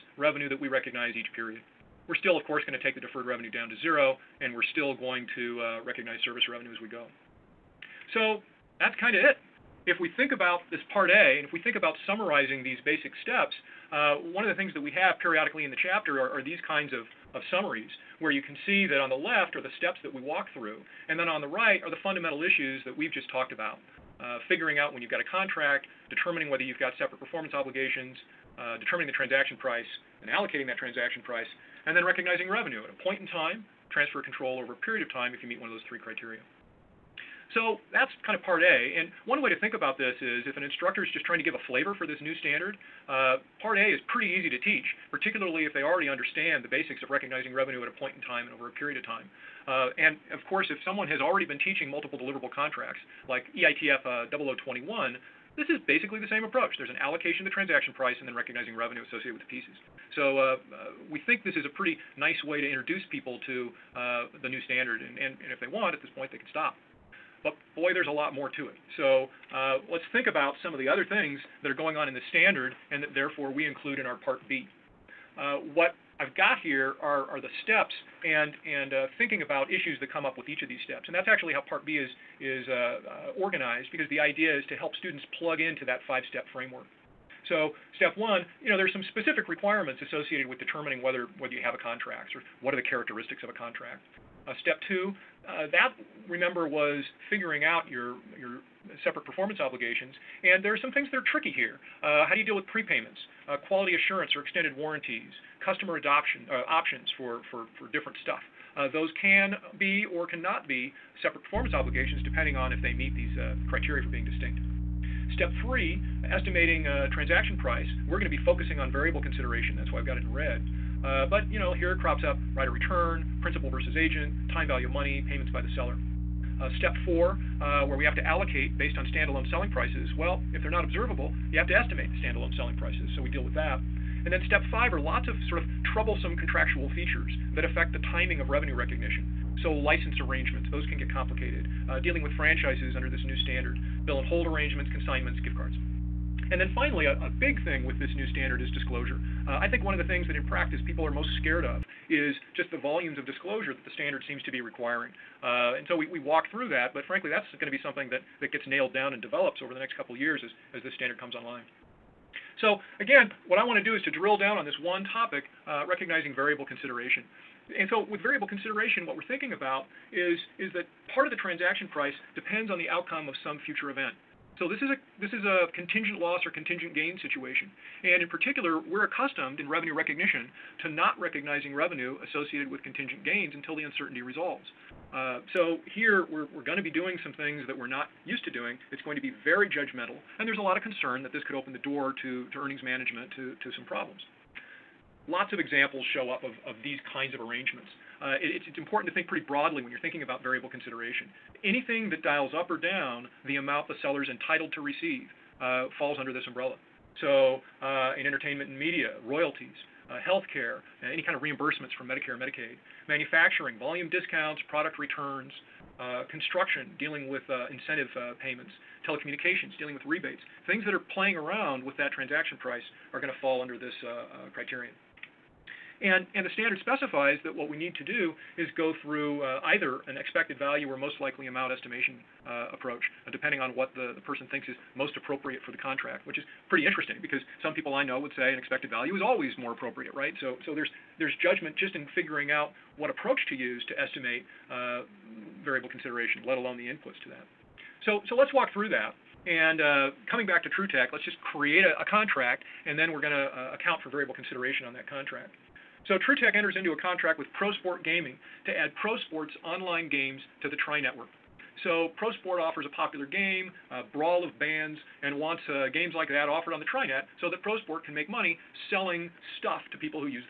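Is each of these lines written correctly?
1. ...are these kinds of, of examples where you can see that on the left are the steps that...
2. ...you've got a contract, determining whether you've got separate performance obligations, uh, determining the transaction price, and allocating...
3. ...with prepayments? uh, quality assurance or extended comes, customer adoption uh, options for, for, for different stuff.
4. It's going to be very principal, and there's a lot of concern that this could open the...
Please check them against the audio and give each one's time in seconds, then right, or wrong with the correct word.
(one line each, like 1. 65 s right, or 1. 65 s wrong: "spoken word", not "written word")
1. 16 s wrong: "summaries", not "examples"
2. 25 s right
3. 102 s wrong: "warranties", not "comes"
4. 188 s wrong: "judgmental", not "principal".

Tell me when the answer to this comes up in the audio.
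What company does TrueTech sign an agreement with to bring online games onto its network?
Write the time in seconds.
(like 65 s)
257 s.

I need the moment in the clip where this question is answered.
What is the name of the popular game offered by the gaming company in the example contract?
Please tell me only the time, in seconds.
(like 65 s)
264 s.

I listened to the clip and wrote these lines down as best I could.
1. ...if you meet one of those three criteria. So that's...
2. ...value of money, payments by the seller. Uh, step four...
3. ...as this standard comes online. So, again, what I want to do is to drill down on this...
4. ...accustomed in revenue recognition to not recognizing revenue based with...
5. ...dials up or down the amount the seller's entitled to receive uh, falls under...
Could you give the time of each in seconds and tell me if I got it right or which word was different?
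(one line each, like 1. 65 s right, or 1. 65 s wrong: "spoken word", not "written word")
1. 35 s right
2. 124 s right
3. 160 s right
4. 179 s wrong: "associated", not "based"
5. 202 s right.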